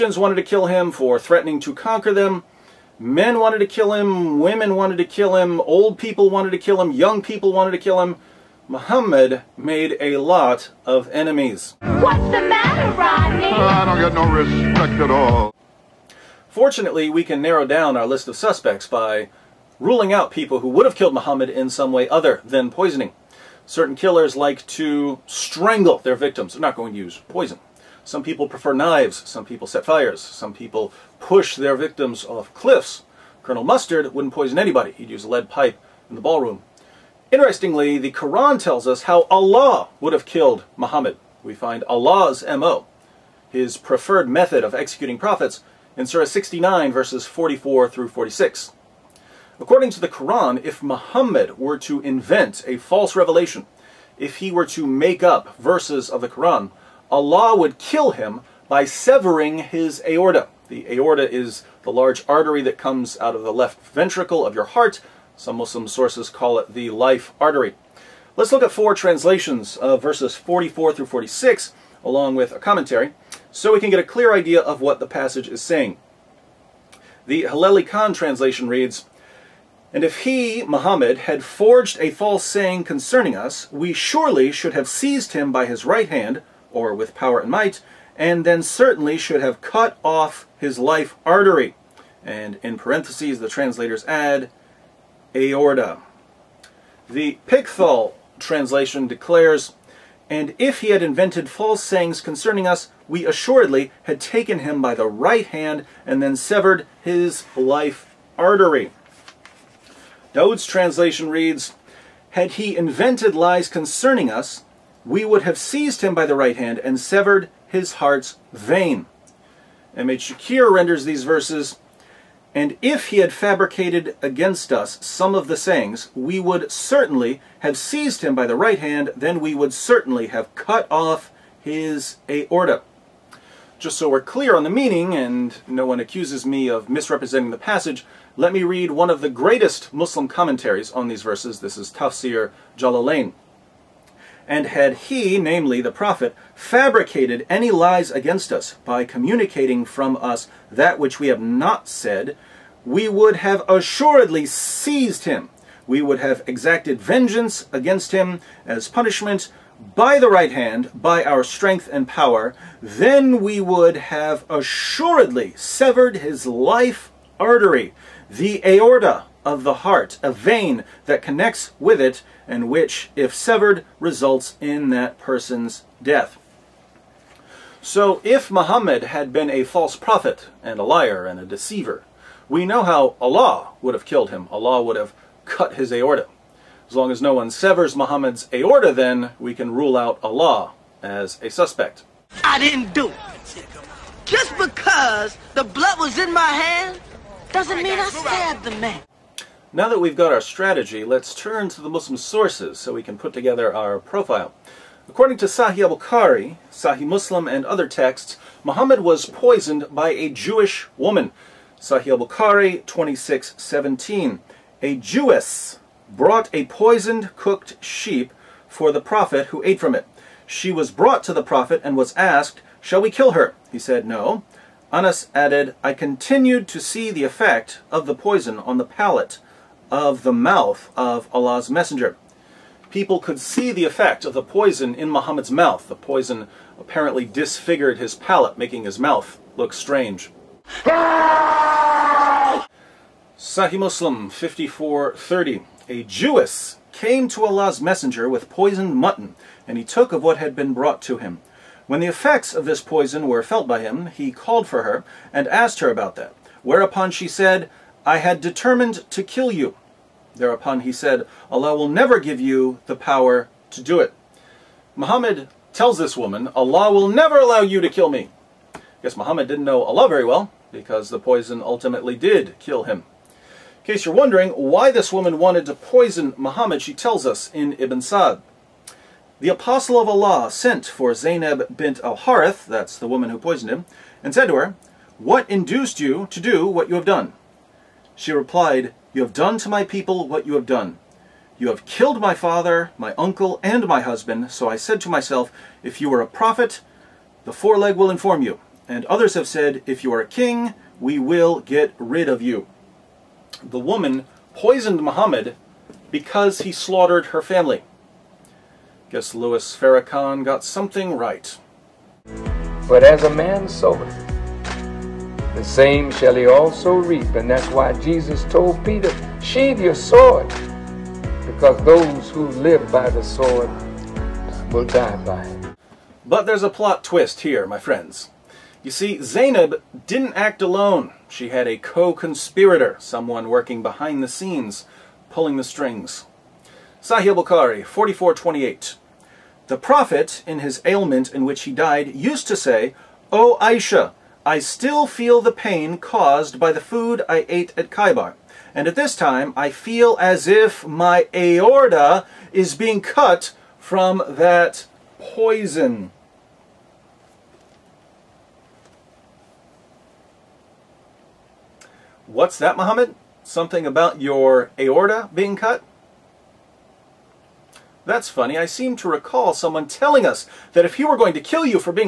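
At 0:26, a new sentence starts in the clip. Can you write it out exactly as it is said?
They're not going to use poison.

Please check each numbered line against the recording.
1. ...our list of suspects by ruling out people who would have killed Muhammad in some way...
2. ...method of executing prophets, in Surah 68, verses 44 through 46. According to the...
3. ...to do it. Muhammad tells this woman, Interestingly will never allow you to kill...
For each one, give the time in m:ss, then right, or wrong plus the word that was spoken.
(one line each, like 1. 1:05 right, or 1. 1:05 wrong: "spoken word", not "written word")
1. 0:17 right
2. 0:44 wrong: "69", not "68"
3. 4:23 wrong: "Allah", not "Interestingly".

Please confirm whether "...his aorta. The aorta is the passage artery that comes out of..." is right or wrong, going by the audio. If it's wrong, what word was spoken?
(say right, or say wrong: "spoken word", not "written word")
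wrong: "large", not "passage".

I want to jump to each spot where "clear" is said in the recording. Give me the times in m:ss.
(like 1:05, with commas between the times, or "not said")
1:14, 2:14.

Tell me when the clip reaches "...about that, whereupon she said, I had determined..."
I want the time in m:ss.
4:15.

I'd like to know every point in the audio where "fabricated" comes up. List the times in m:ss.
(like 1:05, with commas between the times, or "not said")
2:03, 2:26.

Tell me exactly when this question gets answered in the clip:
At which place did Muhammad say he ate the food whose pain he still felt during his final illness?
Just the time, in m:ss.
5:47.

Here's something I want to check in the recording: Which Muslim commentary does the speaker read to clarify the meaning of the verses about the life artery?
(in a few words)
Tafsir Jalalain.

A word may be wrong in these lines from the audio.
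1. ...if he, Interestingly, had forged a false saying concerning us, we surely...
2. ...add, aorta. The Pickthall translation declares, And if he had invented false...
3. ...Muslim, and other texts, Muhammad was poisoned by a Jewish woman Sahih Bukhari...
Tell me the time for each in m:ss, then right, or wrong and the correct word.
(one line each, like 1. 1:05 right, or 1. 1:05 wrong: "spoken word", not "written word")
1. 1:20 wrong: "Muhammad", not "Interestingly"
2. 1:34 right
3. 3:27 right.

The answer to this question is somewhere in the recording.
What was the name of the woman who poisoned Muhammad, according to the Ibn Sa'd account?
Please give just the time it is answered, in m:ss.
4:41.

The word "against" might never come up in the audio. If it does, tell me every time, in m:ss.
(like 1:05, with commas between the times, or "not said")
2:04, 2:28, 2:37.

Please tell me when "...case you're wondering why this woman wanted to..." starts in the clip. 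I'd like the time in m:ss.
4:33.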